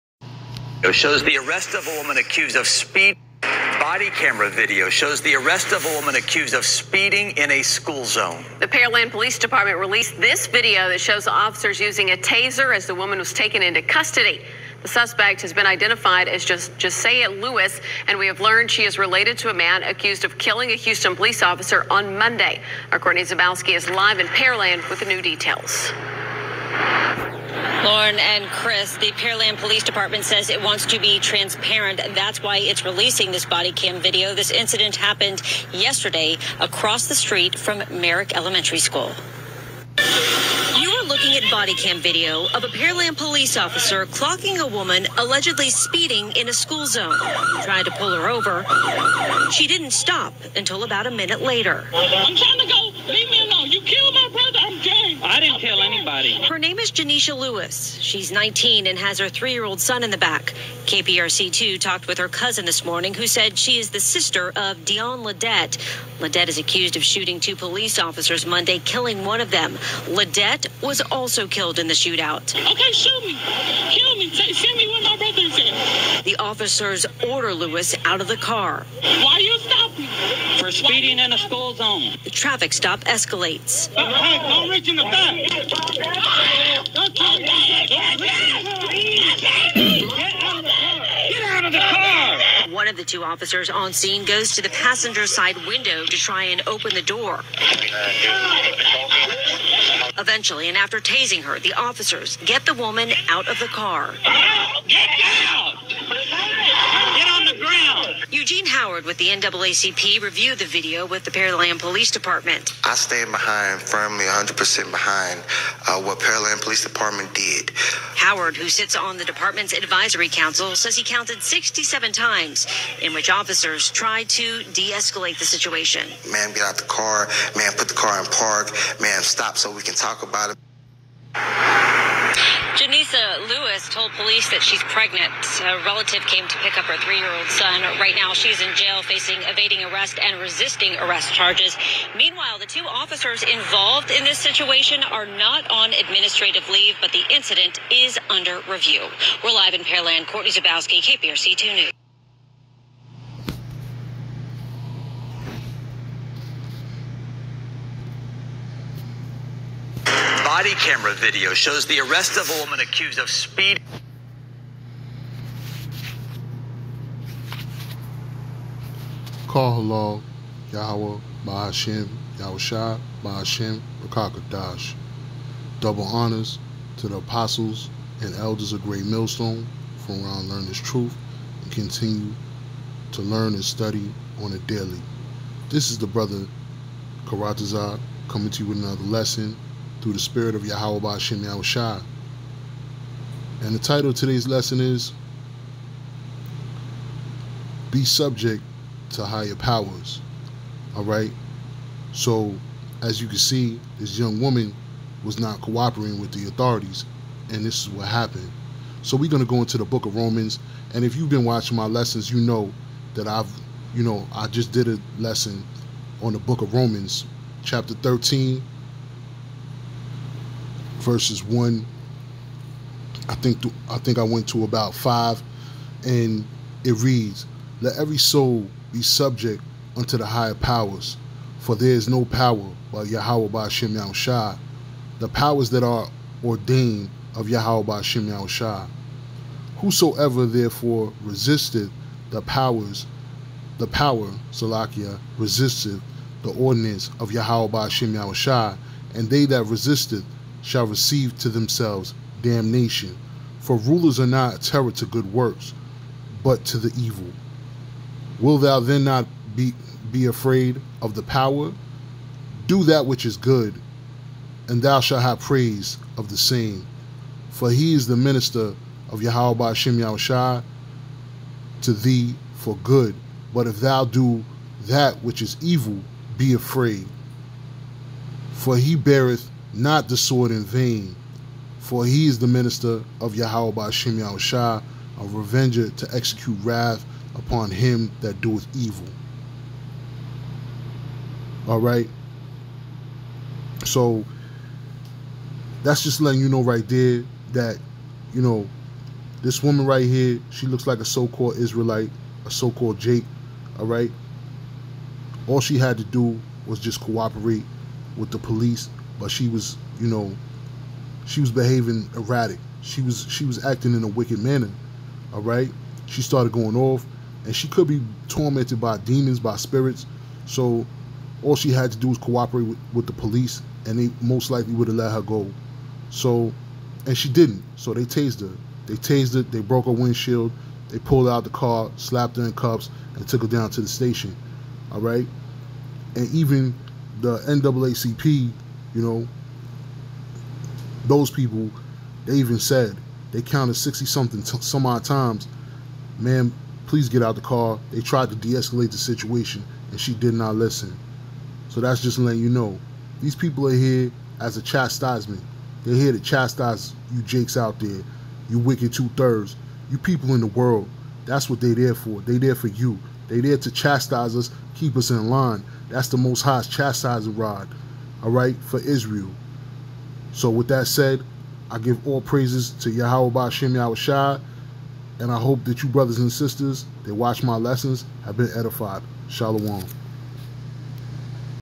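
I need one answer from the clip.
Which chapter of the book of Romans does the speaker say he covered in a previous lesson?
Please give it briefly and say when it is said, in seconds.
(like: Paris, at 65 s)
Chapter 13, at 217 s.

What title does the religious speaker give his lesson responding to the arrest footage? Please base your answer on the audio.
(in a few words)
Be Subject to Higher Powers.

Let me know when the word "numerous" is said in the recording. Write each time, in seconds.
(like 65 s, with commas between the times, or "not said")
not said.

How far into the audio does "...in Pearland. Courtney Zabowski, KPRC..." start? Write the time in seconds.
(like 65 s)
149 s.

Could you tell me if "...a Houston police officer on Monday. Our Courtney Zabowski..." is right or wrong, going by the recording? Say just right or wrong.
right.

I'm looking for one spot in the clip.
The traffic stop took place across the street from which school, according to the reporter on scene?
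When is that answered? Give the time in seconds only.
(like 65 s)
37 s.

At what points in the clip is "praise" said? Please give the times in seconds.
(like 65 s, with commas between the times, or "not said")
265 s, 372 s.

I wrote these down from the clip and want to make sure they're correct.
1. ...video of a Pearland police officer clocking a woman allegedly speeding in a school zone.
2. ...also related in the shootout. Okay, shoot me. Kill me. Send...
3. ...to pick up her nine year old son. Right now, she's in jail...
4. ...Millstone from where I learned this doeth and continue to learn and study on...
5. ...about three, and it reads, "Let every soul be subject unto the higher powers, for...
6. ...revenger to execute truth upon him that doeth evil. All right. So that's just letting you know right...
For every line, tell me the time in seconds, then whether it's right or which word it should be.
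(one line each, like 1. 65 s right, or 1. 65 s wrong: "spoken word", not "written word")
1. 41 s right
2. 71 s wrong: "killed", not "related"
3. 136 s wrong: "three", not "nine"
4. 179 s wrong: "truth", not "doeth"
5. 224 s wrong: "five", not "three"
6. 285 s wrong: "wrath", not "truth".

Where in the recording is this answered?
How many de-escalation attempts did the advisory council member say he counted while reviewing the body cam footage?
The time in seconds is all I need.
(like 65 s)
121 s.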